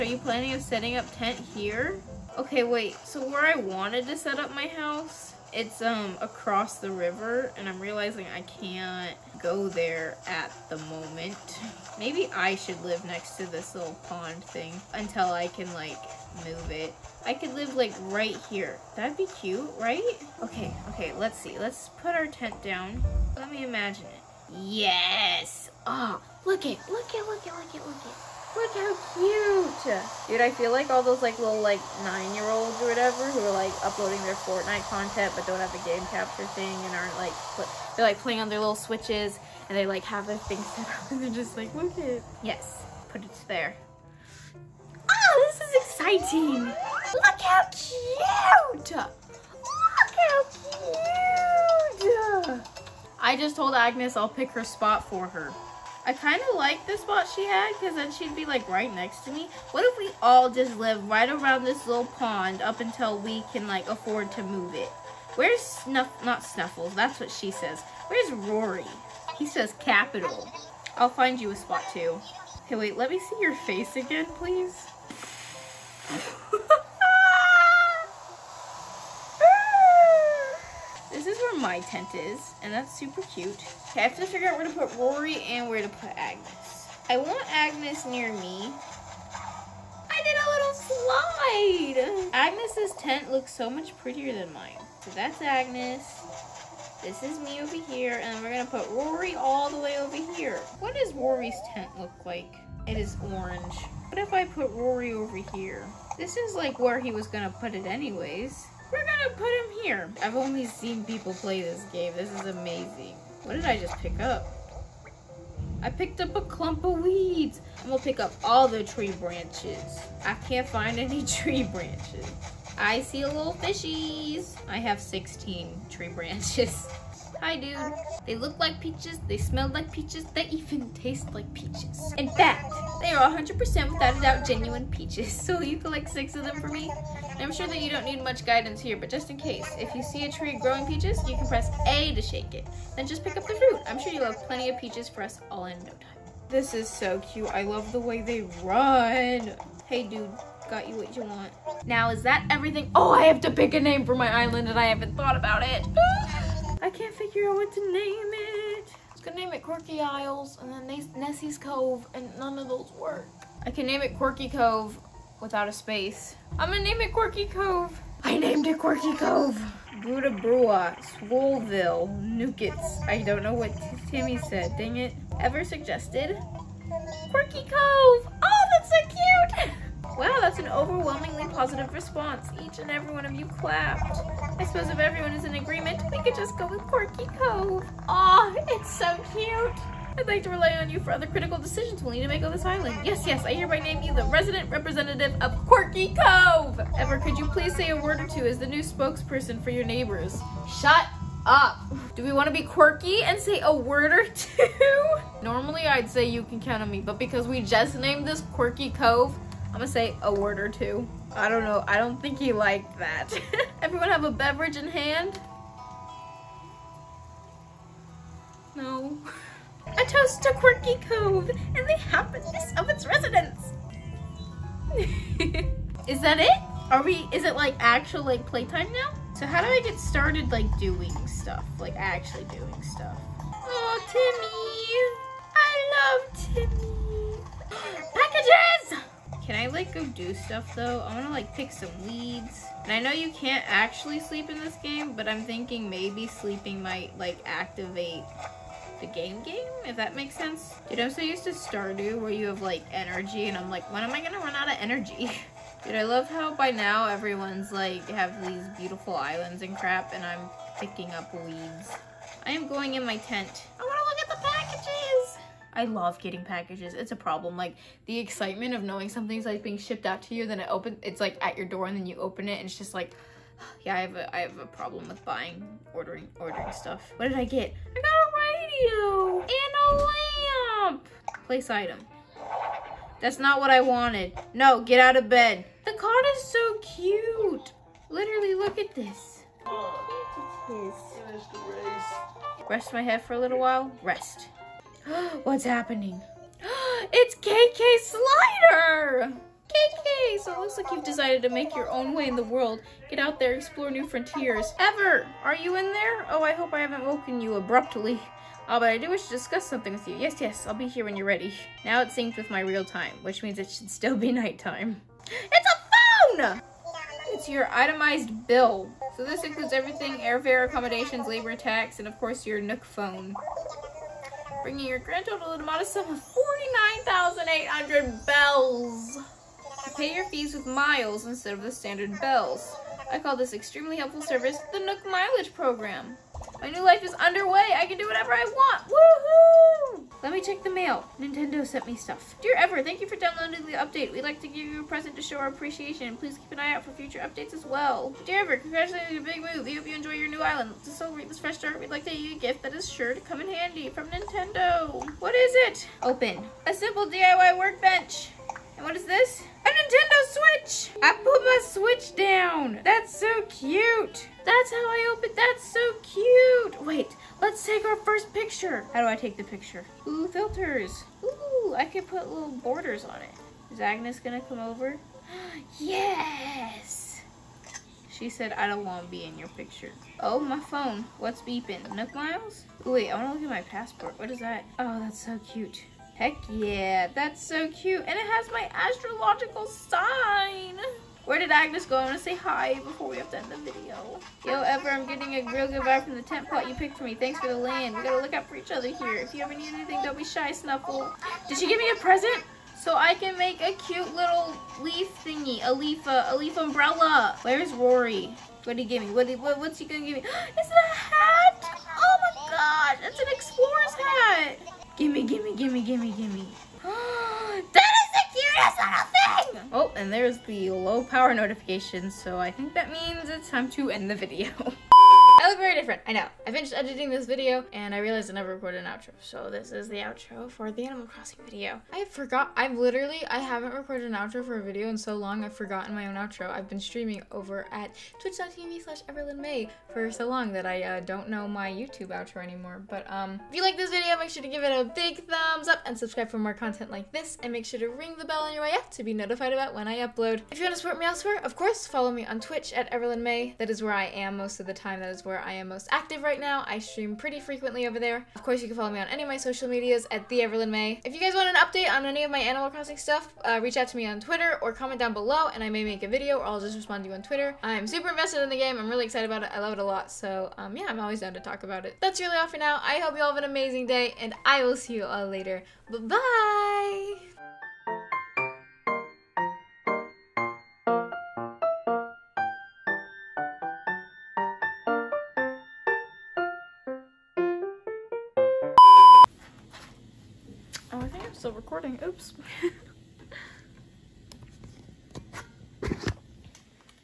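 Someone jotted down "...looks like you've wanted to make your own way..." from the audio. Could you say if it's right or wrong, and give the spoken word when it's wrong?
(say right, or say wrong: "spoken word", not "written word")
wrong: "decided", not "wanted".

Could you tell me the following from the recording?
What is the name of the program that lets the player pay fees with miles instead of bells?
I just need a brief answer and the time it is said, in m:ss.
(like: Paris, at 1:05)
Nook Mileage Program, at 5:34.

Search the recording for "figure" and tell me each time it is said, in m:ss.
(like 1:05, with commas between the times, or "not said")
1:24, 2:37.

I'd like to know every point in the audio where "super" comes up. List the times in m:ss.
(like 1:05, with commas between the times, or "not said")
1:22, 7:47.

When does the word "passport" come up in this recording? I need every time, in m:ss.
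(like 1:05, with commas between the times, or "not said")
6:23.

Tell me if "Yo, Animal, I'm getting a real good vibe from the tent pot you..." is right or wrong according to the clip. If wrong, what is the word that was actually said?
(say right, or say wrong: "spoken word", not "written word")
wrong: "Ever", not "Animal".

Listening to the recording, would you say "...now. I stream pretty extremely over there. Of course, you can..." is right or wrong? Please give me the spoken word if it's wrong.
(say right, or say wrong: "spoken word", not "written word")
wrong: "frequently", not "extremely".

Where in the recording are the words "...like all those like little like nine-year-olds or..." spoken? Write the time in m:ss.
0:30.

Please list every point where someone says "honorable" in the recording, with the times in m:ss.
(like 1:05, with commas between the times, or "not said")
not said.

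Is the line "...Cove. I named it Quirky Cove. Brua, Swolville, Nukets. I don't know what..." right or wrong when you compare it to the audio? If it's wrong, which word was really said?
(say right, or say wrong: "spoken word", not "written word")
right.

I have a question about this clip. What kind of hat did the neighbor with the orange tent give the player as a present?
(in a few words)
explorer's hat.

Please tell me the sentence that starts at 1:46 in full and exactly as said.
This is like where he was gonna put it anyways.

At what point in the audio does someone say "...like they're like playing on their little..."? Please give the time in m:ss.
0:37.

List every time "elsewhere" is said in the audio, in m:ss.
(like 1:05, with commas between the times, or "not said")
7:31.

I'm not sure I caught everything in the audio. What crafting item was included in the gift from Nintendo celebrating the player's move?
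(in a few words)
DIY workbench.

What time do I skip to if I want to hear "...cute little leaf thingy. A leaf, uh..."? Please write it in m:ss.
6:43.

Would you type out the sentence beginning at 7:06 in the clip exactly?
I finished editing this video and I realized I never recorded an outro.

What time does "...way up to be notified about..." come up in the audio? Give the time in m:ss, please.
7:28.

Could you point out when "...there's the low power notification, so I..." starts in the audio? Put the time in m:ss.
7:00.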